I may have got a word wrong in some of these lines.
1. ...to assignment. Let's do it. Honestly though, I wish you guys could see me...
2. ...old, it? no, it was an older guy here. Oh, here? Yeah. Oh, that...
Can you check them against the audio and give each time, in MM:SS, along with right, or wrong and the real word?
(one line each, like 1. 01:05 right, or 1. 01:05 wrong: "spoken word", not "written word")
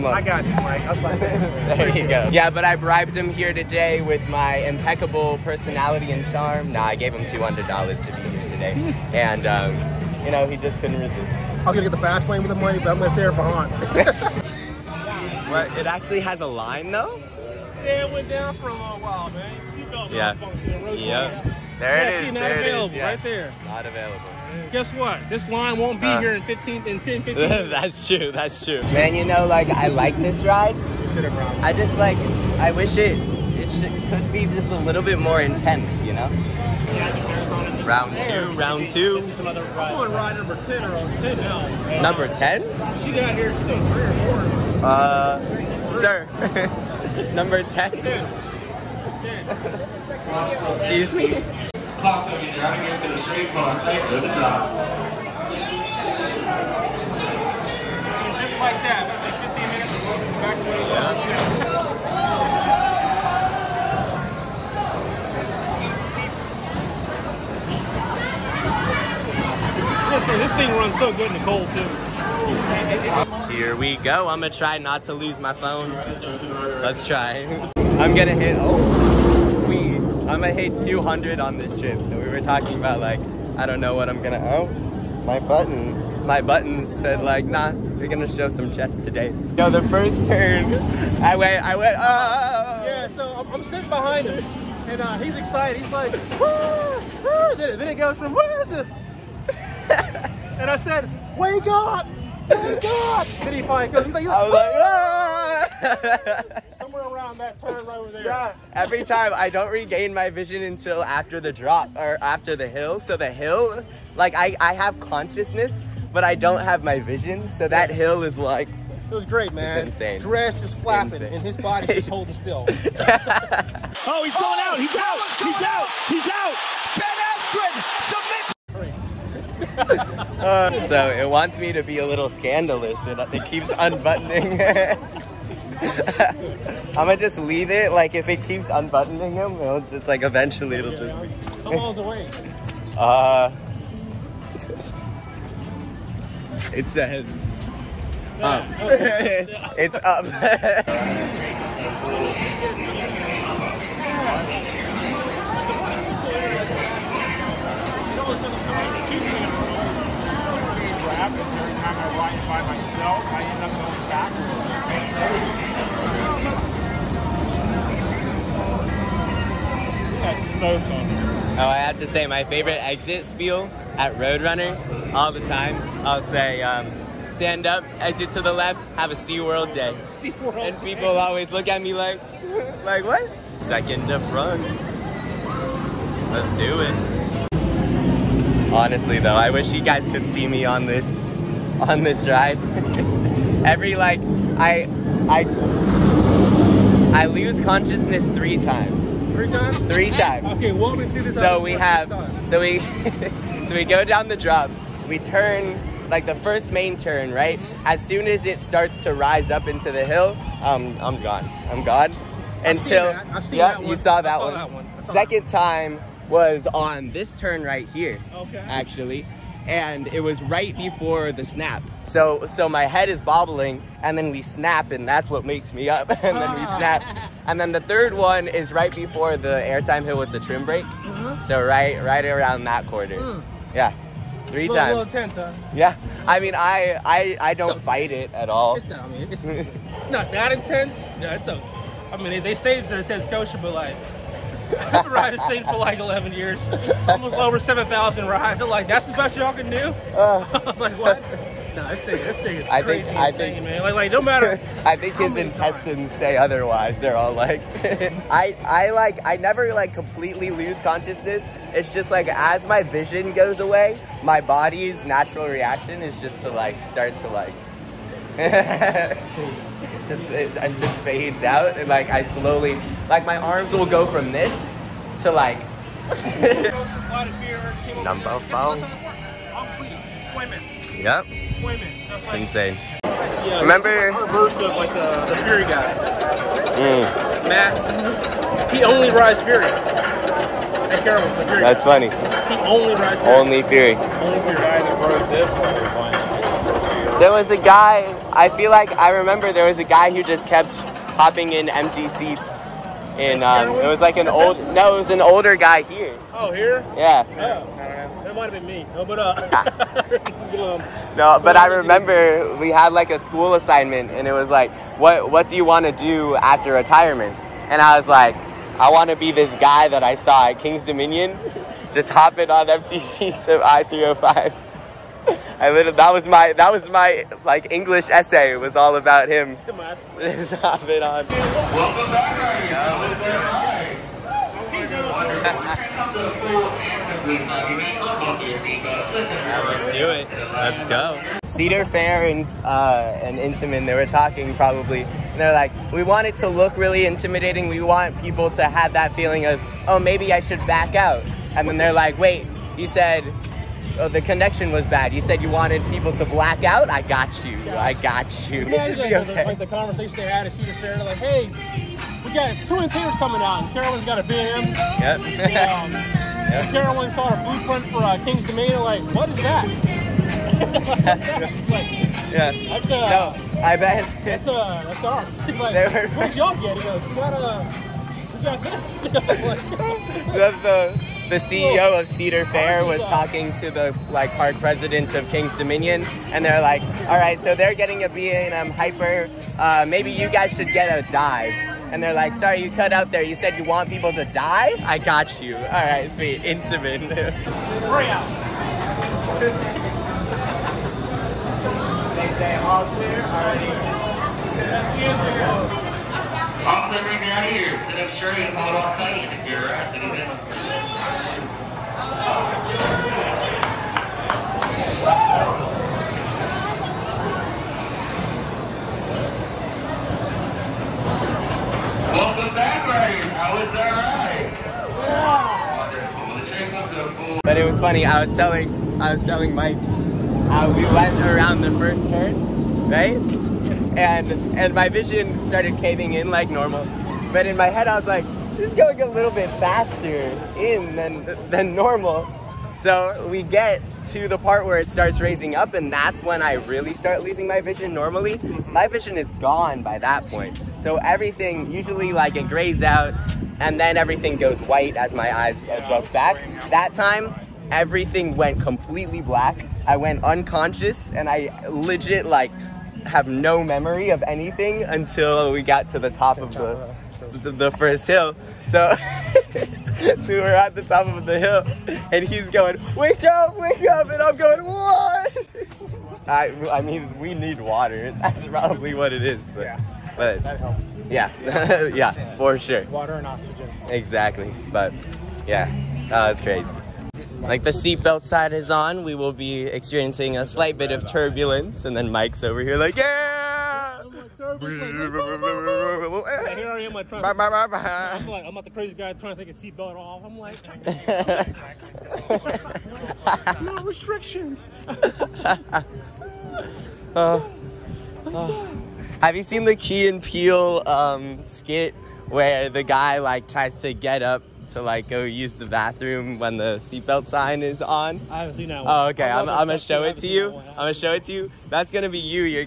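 1. 03:04 wrong: "front", not "assignment"
2. 05:04 right.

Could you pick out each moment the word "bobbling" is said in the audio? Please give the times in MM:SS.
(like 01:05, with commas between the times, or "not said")
03:43.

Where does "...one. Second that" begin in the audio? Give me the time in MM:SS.
03:34.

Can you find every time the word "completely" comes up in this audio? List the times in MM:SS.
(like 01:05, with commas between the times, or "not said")
04:19, 07:38.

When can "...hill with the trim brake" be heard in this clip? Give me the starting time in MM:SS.
03:50.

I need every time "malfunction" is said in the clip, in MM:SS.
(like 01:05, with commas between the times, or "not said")
00:20.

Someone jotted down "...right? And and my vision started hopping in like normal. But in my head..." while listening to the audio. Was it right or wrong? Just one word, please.
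wrong.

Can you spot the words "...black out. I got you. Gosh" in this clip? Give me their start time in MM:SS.
05:56.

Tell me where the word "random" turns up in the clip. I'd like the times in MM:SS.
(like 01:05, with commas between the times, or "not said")
not said.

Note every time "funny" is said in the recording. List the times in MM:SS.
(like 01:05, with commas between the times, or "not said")
04:51, 07:07.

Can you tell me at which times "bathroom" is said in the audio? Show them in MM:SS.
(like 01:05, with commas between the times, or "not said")
08:35.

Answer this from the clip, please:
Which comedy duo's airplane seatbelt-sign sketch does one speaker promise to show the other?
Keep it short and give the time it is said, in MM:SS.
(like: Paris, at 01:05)
Key and Peele, at 08:29.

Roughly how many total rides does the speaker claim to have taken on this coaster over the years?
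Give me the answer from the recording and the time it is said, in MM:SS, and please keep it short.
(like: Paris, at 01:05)
over 7,000, at 04:07.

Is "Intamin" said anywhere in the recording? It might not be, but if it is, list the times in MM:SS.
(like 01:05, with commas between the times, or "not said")
05:43, 06:36.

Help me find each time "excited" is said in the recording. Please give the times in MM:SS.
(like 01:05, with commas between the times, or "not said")
01:35.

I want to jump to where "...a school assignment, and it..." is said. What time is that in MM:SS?
05:13.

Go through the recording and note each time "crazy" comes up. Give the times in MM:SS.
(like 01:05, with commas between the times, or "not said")
04:12, 08:06, 08:18.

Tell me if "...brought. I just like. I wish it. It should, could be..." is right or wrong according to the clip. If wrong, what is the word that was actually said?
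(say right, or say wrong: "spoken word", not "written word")
right.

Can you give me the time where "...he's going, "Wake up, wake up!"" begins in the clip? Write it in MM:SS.
07:52.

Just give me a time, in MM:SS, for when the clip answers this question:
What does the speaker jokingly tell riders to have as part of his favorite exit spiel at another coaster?
02:58.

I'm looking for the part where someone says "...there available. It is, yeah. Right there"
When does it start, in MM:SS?
00:22.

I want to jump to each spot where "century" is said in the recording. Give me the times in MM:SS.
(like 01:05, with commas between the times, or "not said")
not said.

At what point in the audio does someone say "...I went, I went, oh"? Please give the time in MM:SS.
01:31.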